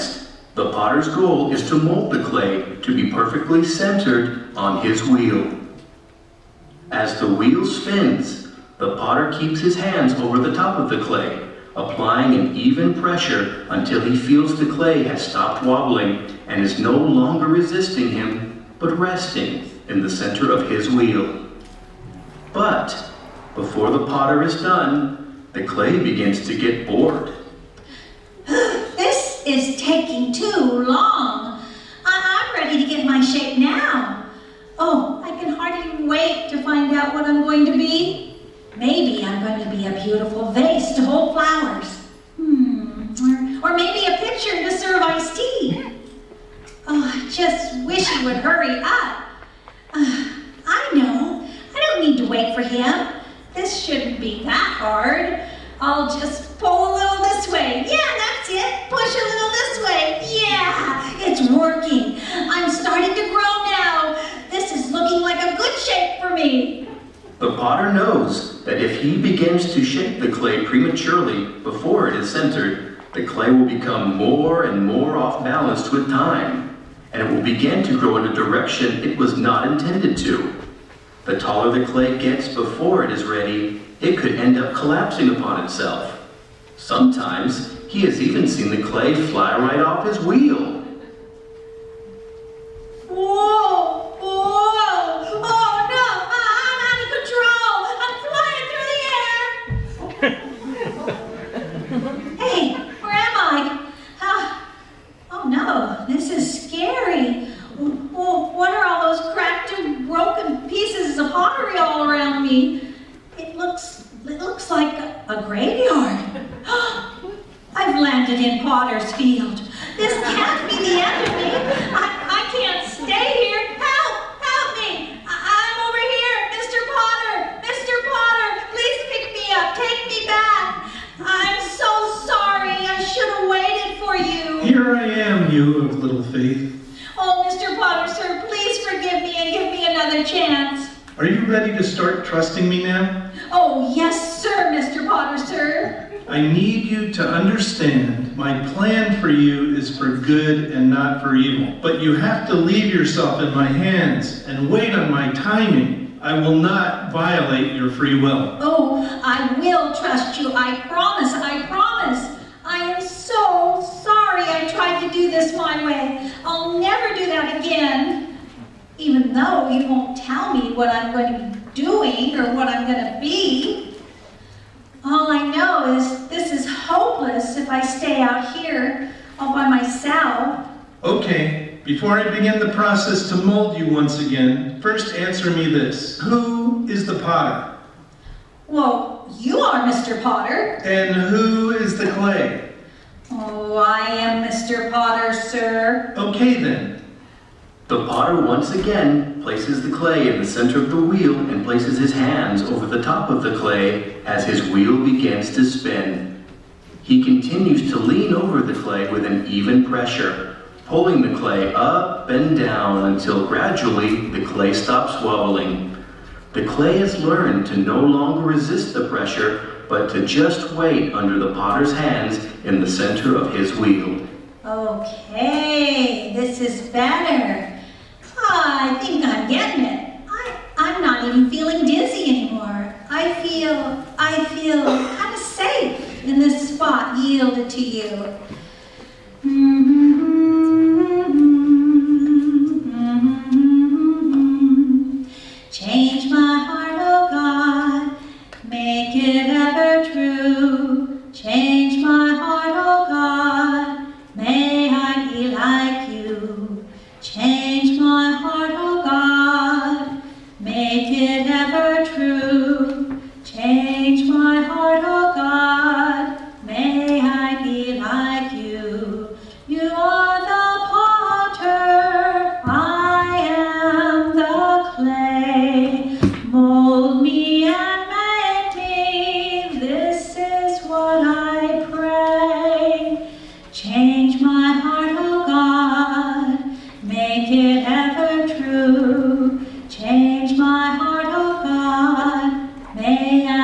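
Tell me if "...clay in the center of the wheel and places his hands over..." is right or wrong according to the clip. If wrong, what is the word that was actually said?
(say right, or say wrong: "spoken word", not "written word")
right.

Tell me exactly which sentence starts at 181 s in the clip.
Okay, before I begin the process to mold you once again, first answer me this.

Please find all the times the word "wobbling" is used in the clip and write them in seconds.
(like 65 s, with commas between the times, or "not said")
15 s, 215 s.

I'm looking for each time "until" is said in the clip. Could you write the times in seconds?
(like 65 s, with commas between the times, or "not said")
13 s, 213 s.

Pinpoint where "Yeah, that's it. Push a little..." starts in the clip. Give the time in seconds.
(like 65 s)
57 s.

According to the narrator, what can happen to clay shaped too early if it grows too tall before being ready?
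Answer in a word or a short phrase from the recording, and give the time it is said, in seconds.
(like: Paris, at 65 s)
collapsing upon itself, at 84 s.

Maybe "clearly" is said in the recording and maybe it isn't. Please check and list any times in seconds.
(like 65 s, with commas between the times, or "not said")
not said.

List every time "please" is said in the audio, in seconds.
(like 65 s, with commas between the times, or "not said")
138 s.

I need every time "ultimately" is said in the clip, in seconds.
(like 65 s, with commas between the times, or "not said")
not said.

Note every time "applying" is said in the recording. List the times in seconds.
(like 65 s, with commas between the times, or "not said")
11 s.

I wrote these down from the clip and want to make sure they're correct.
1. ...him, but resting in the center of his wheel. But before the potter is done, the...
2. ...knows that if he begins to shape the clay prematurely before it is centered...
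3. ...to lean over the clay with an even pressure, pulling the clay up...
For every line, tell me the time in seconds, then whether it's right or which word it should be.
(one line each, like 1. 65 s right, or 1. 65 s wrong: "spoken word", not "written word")
1. 18 s right
2. 67 s right
3. 207 s right.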